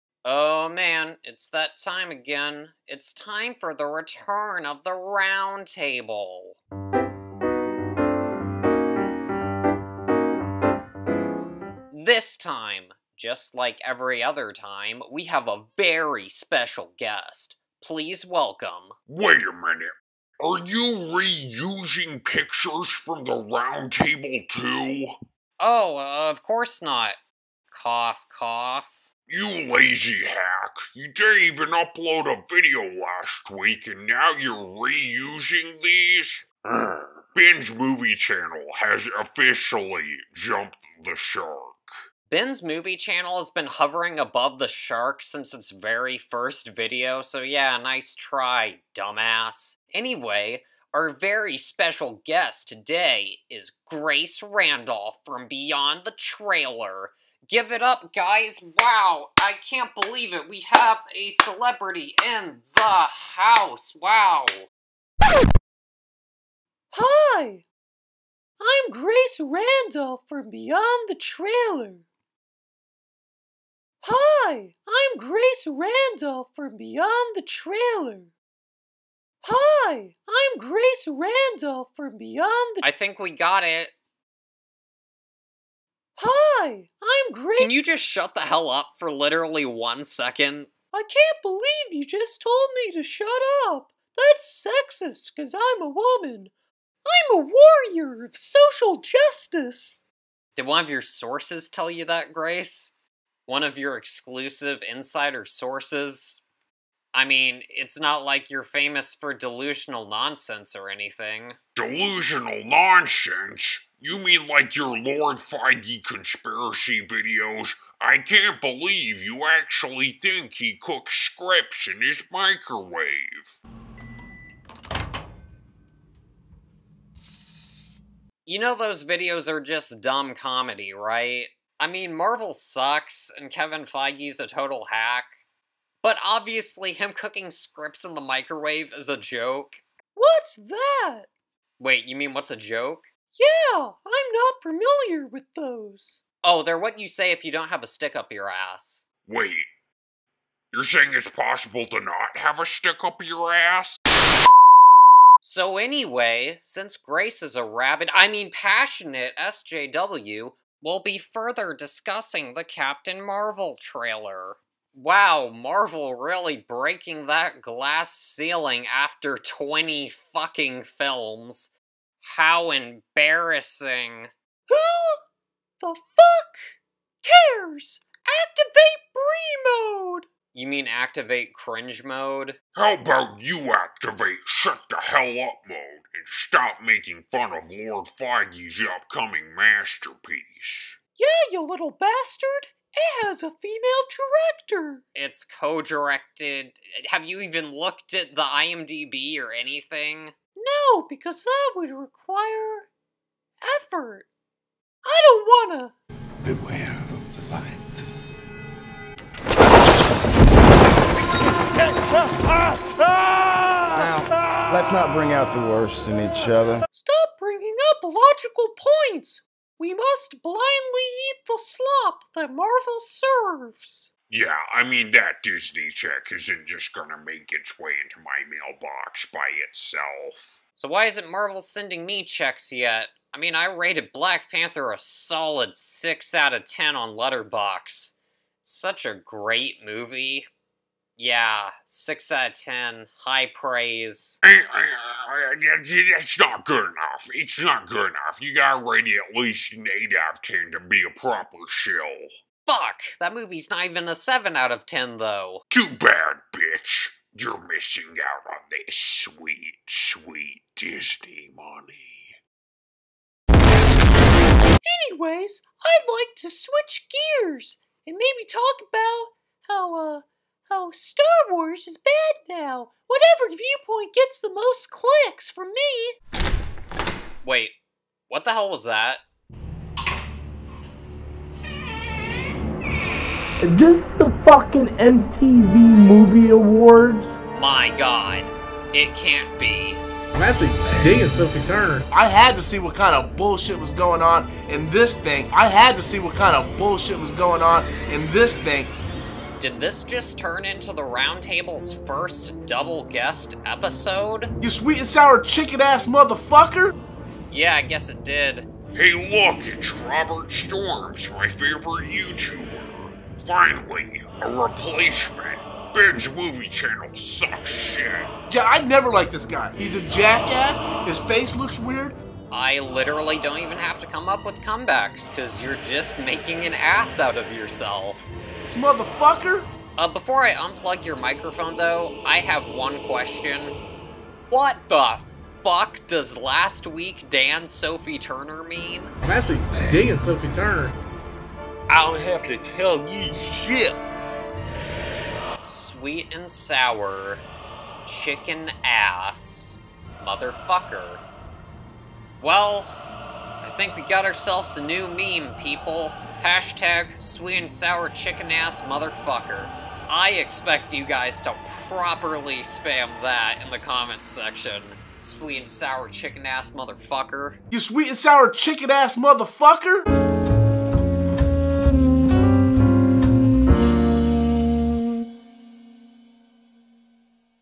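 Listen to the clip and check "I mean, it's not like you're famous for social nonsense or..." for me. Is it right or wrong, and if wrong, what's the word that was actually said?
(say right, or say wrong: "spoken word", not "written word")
wrong: "delusional", not "social".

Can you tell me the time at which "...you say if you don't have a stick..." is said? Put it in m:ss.
2:26.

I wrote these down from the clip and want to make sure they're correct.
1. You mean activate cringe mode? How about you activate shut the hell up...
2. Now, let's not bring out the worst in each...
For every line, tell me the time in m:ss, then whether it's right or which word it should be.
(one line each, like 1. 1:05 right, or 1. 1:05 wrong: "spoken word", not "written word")
1. 3:00 right
2. 3:31 right.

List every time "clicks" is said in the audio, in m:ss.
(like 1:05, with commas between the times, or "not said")
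4:34.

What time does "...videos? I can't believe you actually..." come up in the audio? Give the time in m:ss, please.
1:57.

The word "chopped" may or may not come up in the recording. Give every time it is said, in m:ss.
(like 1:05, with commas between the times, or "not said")
not said.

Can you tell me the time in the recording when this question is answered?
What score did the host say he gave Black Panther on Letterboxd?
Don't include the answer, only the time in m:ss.
3:55.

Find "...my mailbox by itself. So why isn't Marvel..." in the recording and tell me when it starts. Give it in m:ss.
3:48.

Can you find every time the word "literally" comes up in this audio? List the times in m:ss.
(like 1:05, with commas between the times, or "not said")
1:29, 5:22.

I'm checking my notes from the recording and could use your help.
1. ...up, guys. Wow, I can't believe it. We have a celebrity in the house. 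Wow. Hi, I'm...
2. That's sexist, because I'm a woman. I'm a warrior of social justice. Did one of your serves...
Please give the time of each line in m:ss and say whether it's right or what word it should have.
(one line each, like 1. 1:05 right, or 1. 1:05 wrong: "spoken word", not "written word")
1. 0:57 right
2. 1:34 wrong: "sources", not "serves".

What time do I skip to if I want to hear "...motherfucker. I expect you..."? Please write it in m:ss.
5:58.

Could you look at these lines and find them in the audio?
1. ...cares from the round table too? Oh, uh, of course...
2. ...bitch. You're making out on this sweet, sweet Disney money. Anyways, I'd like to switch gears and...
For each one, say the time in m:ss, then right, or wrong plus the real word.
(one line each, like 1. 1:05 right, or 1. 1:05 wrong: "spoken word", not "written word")
1. 0:22 wrong: "pictures", not "cares"
2. 4:16 wrong: "missing", not "making".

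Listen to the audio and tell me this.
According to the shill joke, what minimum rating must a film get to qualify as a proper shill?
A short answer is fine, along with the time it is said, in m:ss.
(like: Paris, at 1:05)
8 out of 10, at 4:09.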